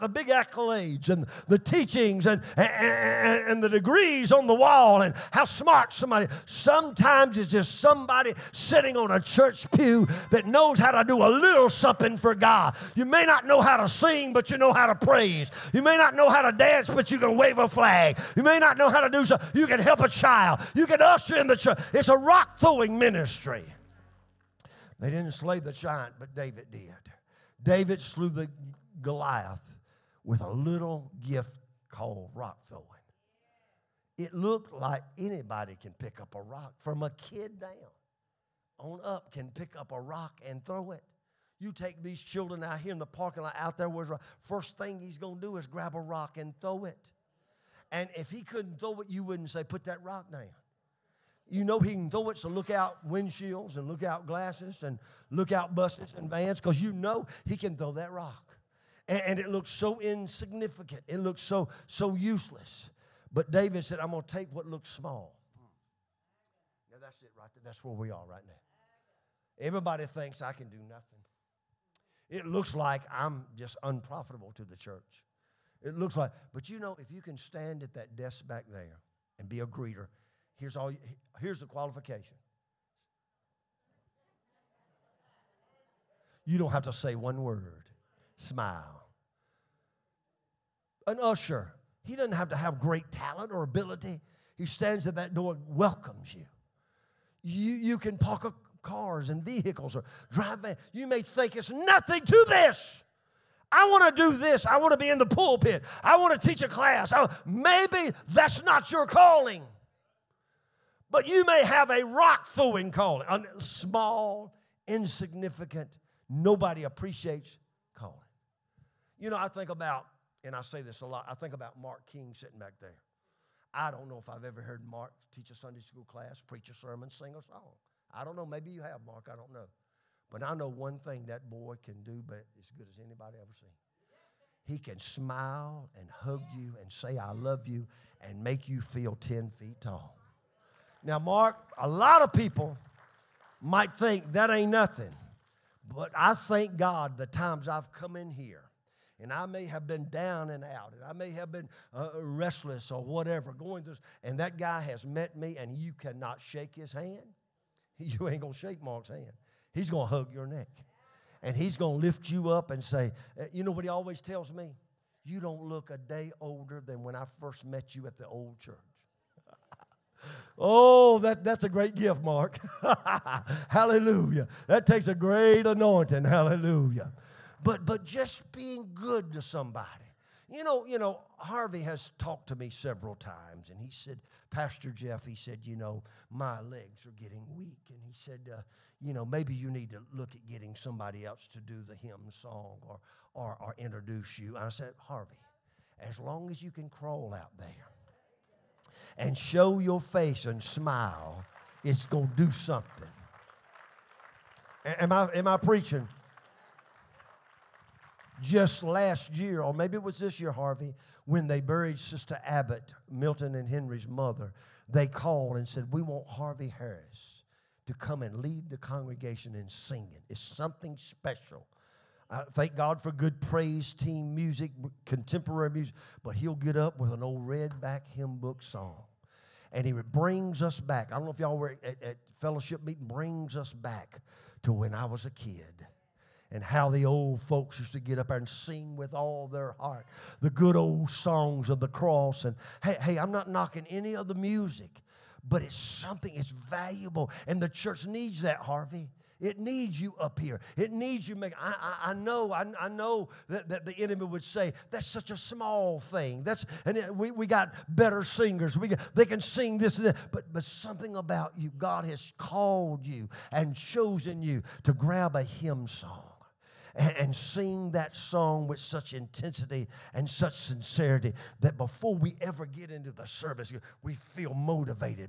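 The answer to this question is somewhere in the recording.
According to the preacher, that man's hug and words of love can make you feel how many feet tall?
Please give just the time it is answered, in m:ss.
2:19.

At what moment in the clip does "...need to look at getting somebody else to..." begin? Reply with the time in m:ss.
3:09.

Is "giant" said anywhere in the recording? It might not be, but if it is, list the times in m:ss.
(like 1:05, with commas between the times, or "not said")
0:25.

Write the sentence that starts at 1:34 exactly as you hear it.
He stands at that door and welcomes you.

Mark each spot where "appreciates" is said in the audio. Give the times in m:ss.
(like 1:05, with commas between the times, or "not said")
1:56.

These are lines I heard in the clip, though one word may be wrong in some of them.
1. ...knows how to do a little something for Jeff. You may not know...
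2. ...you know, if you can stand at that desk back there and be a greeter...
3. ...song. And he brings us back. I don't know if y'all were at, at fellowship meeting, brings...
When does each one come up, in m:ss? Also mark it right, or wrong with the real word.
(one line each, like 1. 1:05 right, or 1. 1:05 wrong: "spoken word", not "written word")
1. 0:10 wrong: "God", not "Jeff"
2. 1:16 right
3. 3:48 right.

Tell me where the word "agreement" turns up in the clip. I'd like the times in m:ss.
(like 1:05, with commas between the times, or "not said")
not said.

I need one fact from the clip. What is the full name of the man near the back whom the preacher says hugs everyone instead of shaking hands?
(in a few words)
Mark King.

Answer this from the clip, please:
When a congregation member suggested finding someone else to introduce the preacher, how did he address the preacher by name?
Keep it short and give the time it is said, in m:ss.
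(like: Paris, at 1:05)
Pastor Jeff, at 3:04.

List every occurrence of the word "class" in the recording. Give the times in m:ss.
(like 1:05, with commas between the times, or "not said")
1:46, 2:06.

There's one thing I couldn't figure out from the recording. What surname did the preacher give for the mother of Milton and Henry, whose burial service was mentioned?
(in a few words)
Abbott.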